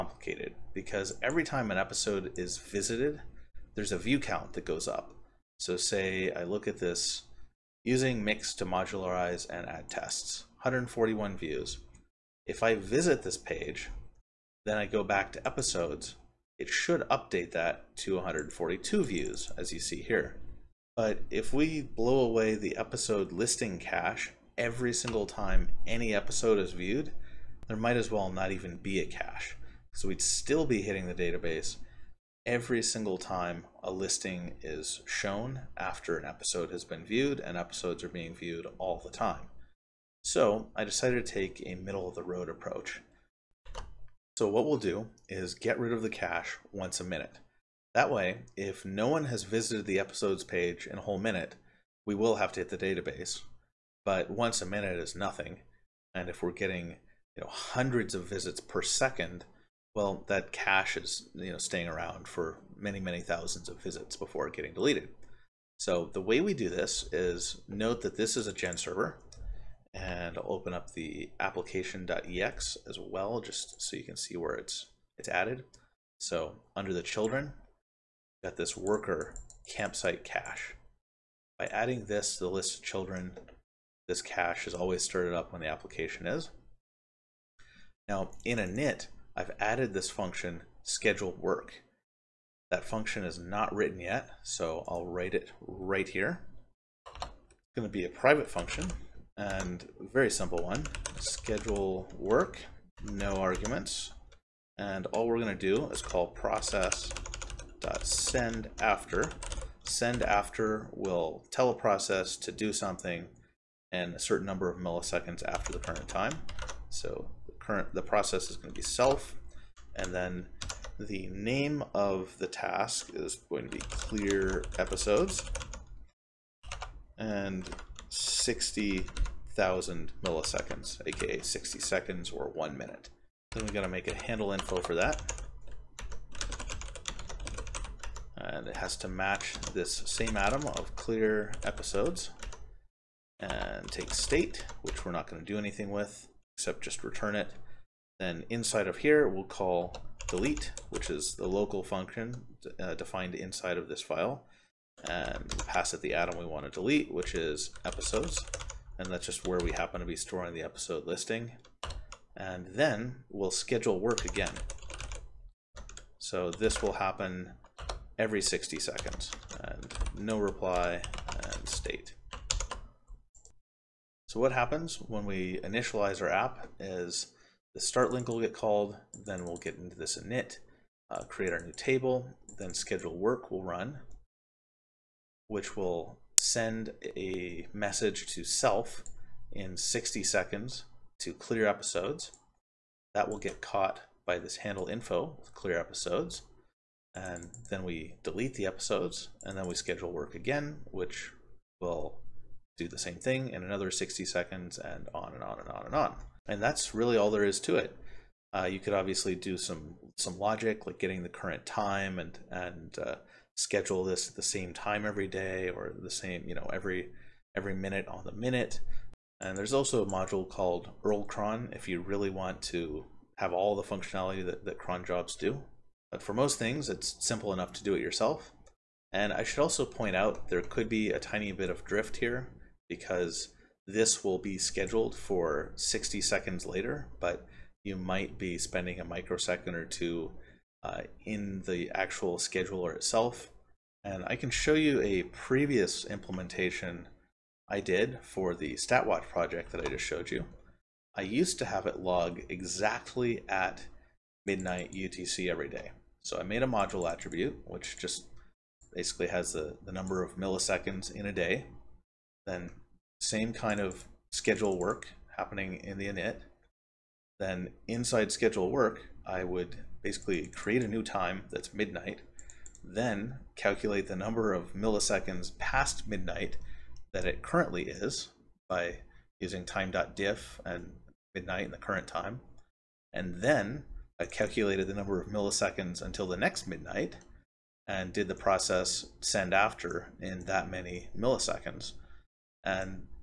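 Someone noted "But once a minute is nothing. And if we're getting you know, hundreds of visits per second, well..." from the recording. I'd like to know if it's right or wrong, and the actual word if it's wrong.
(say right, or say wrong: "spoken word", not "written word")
right.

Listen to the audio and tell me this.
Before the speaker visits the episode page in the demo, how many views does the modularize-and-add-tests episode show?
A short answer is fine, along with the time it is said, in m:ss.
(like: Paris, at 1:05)
141, at 0:10.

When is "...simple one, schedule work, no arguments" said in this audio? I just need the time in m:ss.
1:40.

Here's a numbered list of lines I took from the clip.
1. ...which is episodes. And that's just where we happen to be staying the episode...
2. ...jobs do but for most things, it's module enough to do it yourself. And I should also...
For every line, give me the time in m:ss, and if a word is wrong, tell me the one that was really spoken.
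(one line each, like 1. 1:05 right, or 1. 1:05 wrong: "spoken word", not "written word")
1. 2:37 wrong: "storing", not "staying"
2. 3:45 wrong: "simple", not "module".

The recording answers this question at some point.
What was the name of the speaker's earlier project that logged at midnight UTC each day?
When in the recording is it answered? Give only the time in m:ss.
4:08.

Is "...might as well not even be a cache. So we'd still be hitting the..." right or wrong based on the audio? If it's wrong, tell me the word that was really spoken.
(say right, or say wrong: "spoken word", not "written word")
right.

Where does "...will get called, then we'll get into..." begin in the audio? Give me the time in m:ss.
2:58.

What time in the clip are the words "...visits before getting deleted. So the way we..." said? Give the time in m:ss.
1:03.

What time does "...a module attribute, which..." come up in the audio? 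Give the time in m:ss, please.
4:16.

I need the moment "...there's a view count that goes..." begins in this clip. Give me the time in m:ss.
0:03.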